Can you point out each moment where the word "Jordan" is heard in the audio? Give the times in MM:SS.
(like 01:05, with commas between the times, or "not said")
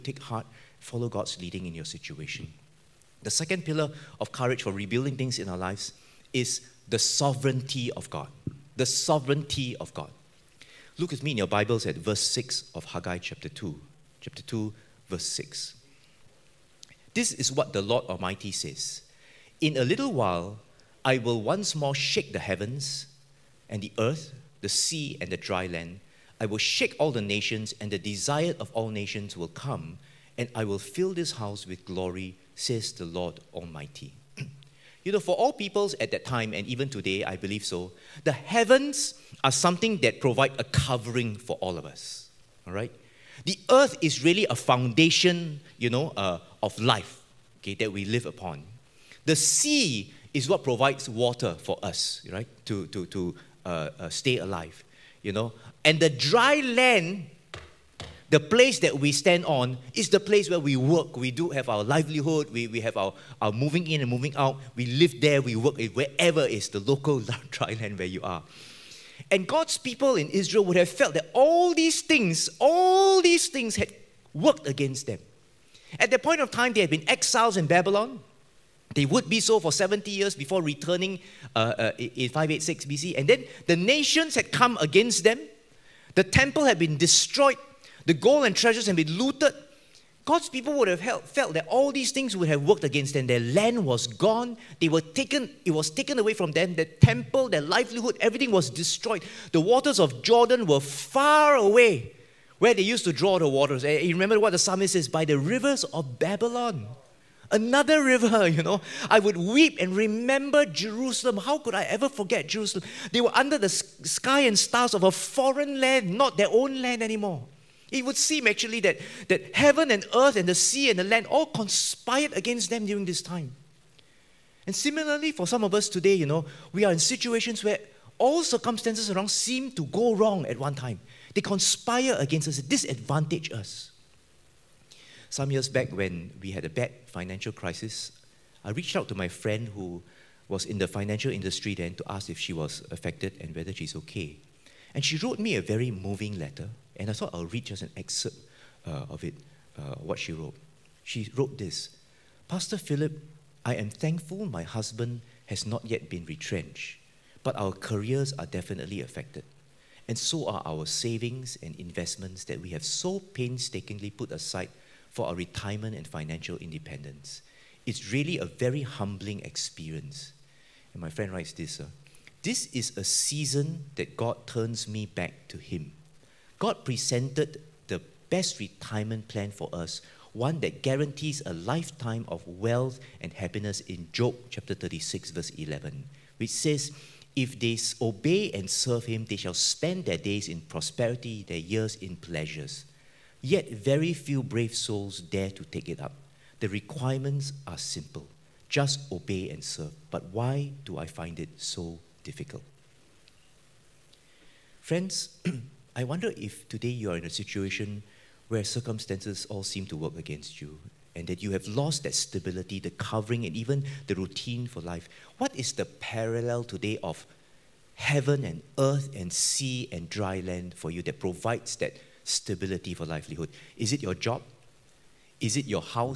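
01:40.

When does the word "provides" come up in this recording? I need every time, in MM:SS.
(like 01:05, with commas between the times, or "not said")
00:40, 00:50, 03:41.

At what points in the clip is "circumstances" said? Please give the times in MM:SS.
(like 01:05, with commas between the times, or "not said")
02:08, 03:28.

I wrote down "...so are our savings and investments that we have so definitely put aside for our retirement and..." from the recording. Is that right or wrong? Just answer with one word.
wrong.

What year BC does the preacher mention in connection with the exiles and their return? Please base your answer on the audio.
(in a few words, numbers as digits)
586 BC.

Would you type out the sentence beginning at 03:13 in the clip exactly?
Yet very few brave souls dare to take it up.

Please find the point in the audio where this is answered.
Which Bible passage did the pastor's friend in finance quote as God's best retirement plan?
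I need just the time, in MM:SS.
03:04.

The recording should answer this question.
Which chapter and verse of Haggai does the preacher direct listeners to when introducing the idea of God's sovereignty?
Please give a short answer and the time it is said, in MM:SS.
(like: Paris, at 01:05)
Chapter 2, verse 6, at 00:11.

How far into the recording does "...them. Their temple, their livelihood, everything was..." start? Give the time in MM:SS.
01:36.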